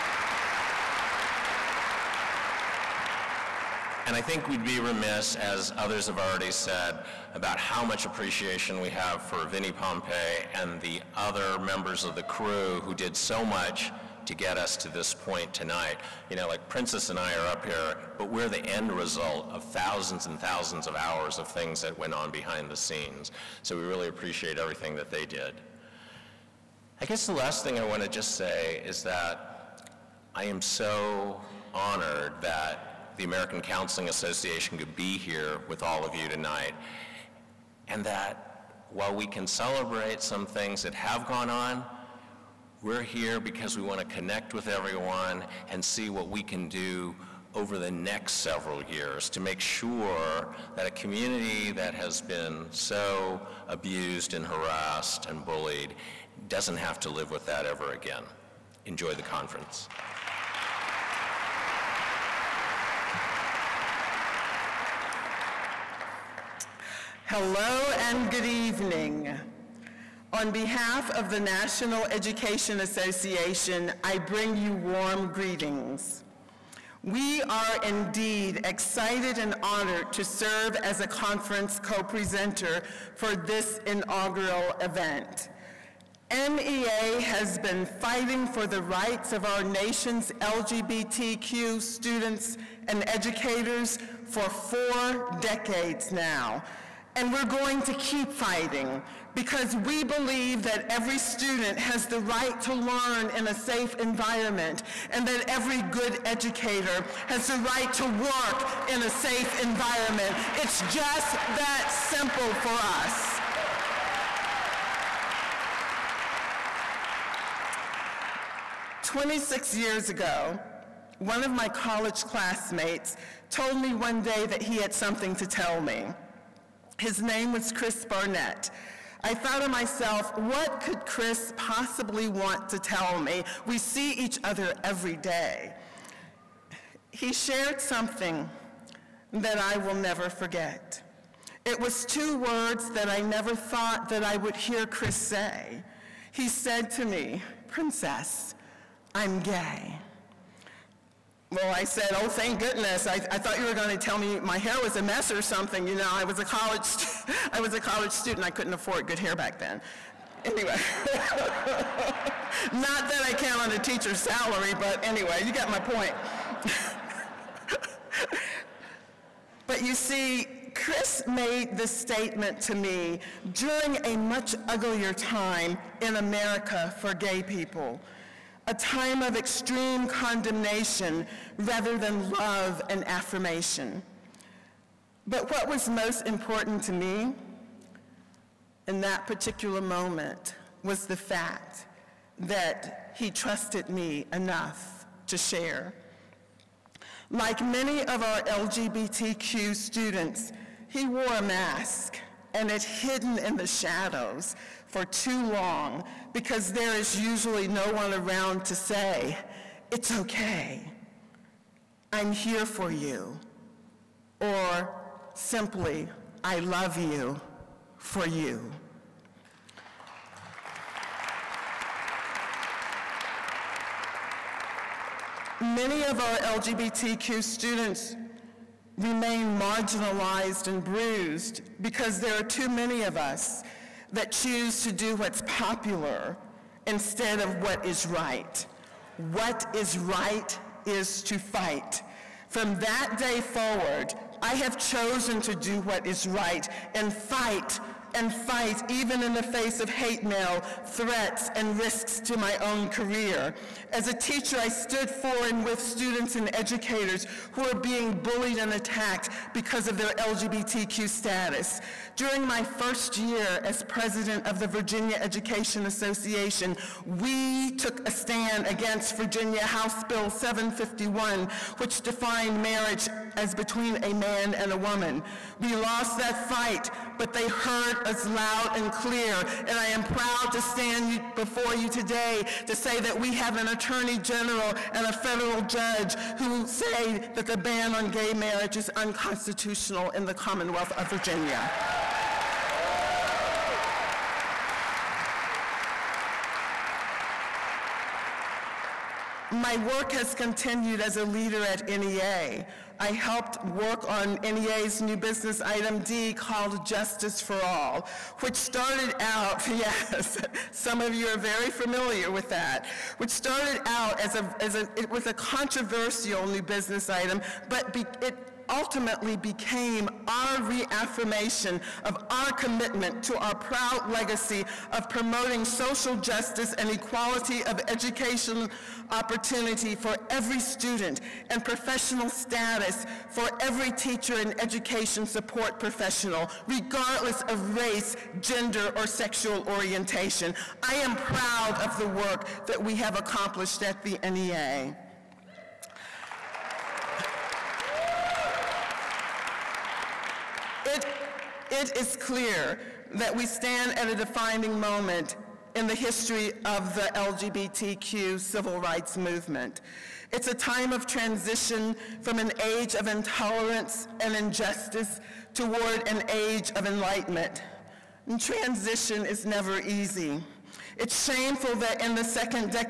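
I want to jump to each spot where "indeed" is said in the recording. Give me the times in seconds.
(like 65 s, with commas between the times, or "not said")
77 s.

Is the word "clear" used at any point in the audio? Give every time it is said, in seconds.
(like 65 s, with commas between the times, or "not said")
278 s, 352 s.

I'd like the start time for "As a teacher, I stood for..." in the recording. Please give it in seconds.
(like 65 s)
253 s.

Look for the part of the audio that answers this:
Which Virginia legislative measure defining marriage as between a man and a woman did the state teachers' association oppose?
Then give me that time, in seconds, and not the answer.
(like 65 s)
269 s.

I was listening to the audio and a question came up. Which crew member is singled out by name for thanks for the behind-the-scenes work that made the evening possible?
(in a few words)
Vinnie Pompei.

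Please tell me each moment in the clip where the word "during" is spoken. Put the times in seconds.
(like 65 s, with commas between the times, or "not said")
173 s, 262 s.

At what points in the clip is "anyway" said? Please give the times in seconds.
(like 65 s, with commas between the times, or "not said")
160 s, 165 s.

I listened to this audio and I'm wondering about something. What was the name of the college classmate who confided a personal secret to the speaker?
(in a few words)
Chris Barnett.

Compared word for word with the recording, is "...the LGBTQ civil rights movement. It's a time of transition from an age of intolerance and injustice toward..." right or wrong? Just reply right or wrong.
right.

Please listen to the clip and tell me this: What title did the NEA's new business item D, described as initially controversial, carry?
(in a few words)
Justice for All.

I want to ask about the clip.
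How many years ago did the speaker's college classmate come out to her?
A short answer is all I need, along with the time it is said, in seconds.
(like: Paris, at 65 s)
26, at 119 s.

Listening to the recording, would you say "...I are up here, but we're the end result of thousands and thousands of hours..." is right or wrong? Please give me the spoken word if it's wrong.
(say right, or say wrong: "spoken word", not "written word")
right.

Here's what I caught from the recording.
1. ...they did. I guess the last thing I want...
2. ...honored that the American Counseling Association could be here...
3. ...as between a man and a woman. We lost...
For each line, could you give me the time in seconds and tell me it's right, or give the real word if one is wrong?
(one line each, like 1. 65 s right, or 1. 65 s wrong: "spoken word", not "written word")
1. 25 s right
2. 31 s right
3. 273 s right.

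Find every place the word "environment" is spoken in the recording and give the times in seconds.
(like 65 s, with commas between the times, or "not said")
103 s, 109 s.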